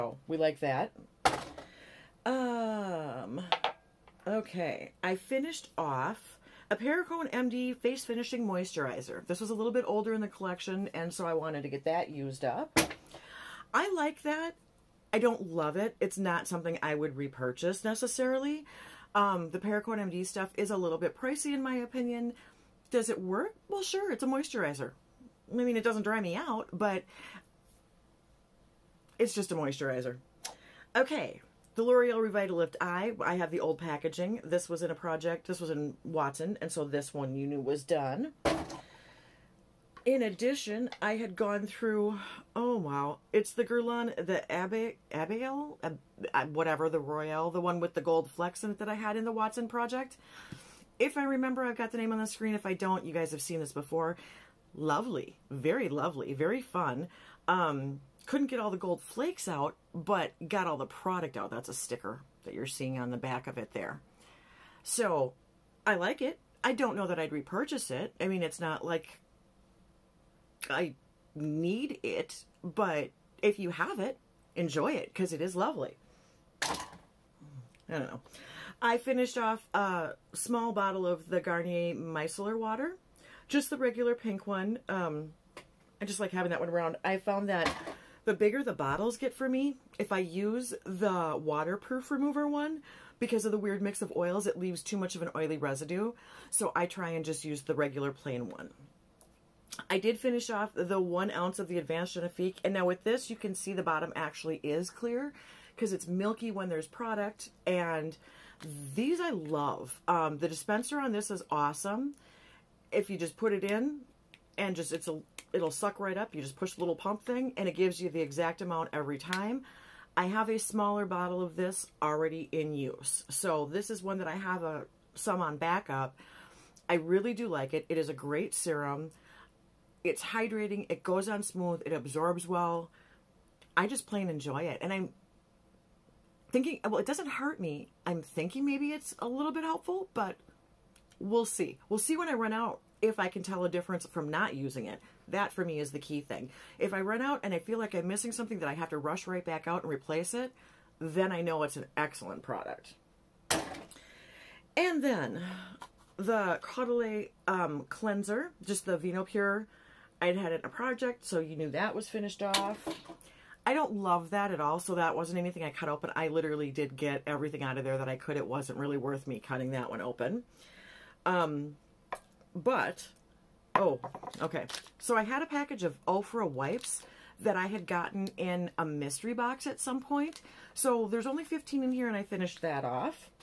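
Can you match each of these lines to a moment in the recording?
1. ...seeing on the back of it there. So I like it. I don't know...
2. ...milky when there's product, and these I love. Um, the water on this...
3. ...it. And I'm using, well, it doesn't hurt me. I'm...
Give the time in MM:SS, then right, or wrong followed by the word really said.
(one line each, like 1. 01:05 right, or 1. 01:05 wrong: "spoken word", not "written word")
1. 01:02 right
2. 01:46 wrong: "dispenser", not "water"
3. 02:14 wrong: "thinking", not "using".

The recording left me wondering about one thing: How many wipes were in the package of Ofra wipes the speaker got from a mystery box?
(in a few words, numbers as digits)
15.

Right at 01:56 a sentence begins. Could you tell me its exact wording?
You just push the little pump thing, and it gives you the exact amount every time.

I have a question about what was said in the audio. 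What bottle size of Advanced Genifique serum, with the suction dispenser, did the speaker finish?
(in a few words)
1 ounce.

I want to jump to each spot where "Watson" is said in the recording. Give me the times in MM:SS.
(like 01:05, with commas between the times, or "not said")
00:36, 00:49.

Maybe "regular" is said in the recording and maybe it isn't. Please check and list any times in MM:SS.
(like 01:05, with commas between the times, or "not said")
01:23, 01:37.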